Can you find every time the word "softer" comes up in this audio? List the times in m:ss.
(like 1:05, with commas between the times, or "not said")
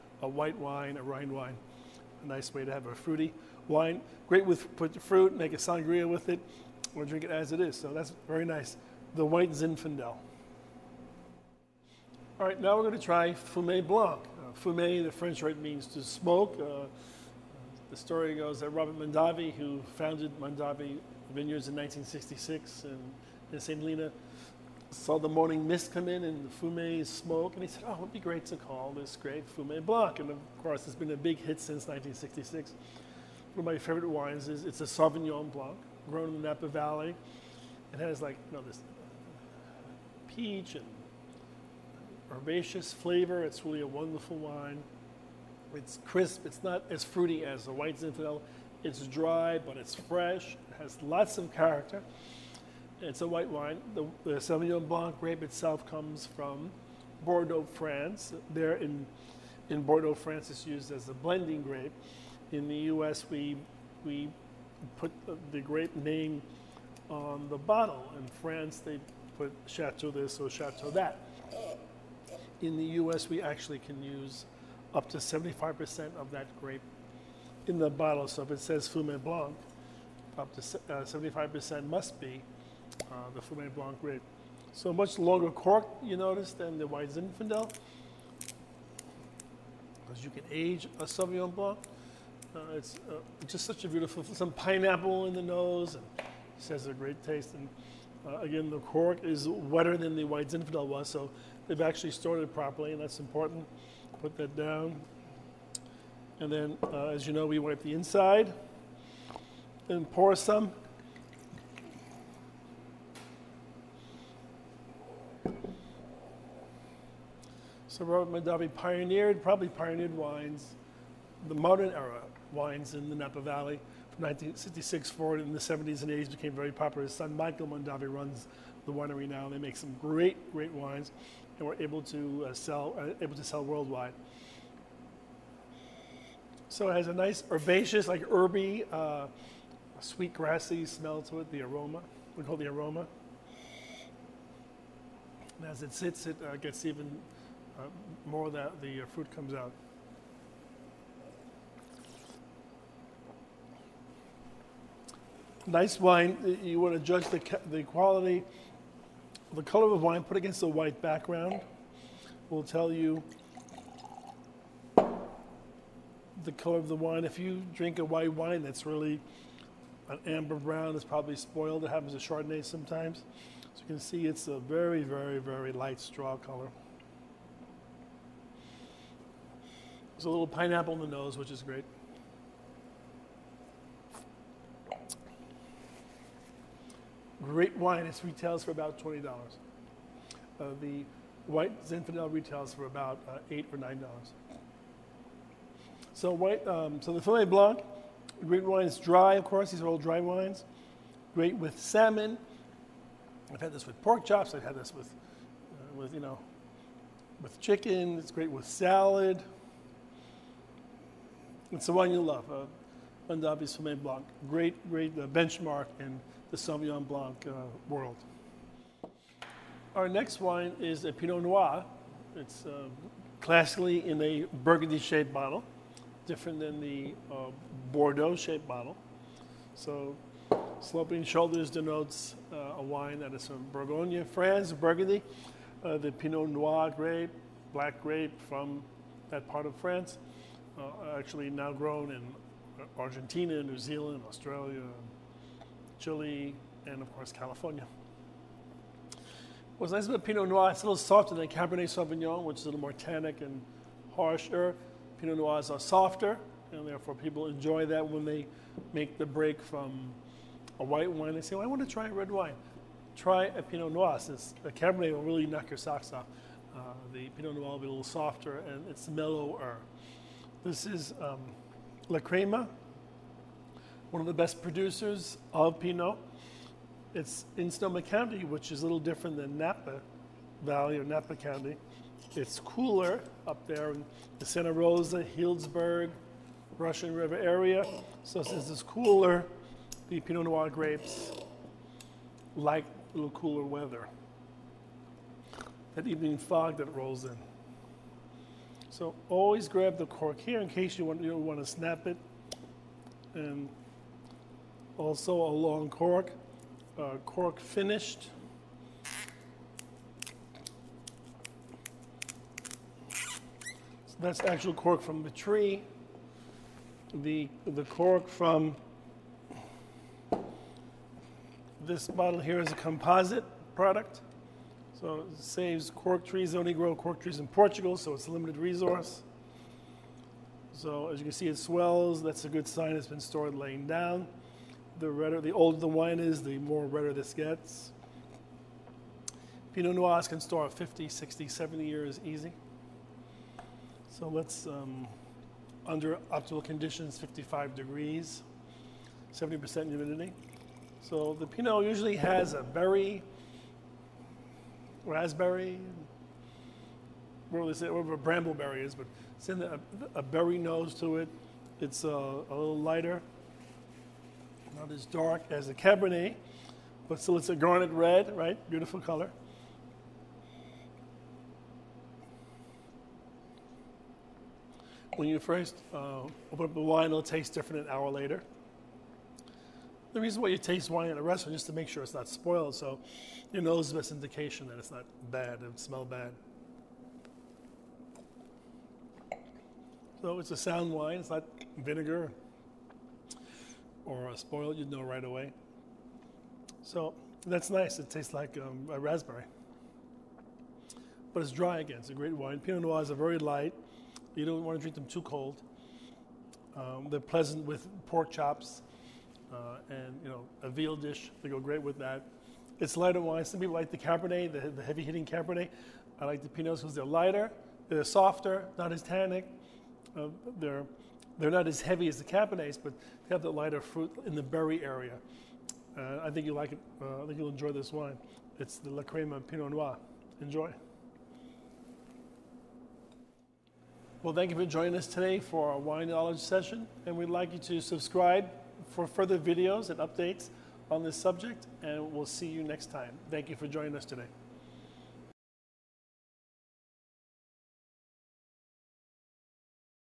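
4:10, 4:15, 4:28, 6:58.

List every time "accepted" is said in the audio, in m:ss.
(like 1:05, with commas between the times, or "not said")
not said.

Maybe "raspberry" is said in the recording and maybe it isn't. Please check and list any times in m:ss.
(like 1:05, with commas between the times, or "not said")
5:55, 6:38.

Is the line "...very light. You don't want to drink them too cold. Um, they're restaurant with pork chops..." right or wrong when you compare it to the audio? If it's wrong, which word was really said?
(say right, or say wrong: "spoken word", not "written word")
wrong: "pleasant", not "restaurant".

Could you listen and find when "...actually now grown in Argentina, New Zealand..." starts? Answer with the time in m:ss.
4:01.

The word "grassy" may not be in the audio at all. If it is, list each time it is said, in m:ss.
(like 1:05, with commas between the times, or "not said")
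2:20.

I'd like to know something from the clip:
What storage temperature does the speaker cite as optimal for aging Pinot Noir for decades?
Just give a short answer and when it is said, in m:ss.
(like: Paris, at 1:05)
55 degrees, at 5:47.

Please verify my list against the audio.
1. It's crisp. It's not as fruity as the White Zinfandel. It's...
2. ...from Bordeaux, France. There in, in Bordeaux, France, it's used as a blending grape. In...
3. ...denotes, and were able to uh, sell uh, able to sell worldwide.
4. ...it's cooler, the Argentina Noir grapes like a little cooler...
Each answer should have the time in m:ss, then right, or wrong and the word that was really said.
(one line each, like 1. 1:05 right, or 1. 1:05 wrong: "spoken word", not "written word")
1. 0:45 right
2. 0:56 right
3. 2:10 wrong: "wines", not "denotes"
4. 4:48 wrong: "Pinot", not "Argentina".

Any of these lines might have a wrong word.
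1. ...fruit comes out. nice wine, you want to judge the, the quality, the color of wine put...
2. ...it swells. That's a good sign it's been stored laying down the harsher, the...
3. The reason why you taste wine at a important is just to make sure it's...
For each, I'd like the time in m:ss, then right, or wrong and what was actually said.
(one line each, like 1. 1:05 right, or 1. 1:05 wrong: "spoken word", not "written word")
1. 2:29 right
2. 5:31 wrong: "redder", not "harsher"
3. 6:20 wrong: "restaurant", not "important".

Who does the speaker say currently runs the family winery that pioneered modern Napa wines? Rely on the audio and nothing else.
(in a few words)
Michael Mondavi.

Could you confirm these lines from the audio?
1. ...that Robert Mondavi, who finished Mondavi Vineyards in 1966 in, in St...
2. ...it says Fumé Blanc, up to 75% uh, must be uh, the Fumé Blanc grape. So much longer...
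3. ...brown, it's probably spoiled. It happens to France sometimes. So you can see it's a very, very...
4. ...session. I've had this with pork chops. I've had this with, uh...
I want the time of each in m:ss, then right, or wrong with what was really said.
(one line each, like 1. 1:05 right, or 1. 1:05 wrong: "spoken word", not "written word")
1. 0:18 wrong: "founded", not "finished"
2. 1:18 right
3. 2:50 wrong: "Chardonnay", not "France"
4. 3:21 wrong: "salmon", not "session".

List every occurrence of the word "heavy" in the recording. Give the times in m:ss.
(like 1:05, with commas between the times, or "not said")
6:54, 7:01.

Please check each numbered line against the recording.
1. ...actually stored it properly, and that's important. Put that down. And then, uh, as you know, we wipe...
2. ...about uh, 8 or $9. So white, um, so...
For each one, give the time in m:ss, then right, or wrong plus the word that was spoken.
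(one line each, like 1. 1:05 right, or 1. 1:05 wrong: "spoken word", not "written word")
1. 1:41 right
2. 3:12 right.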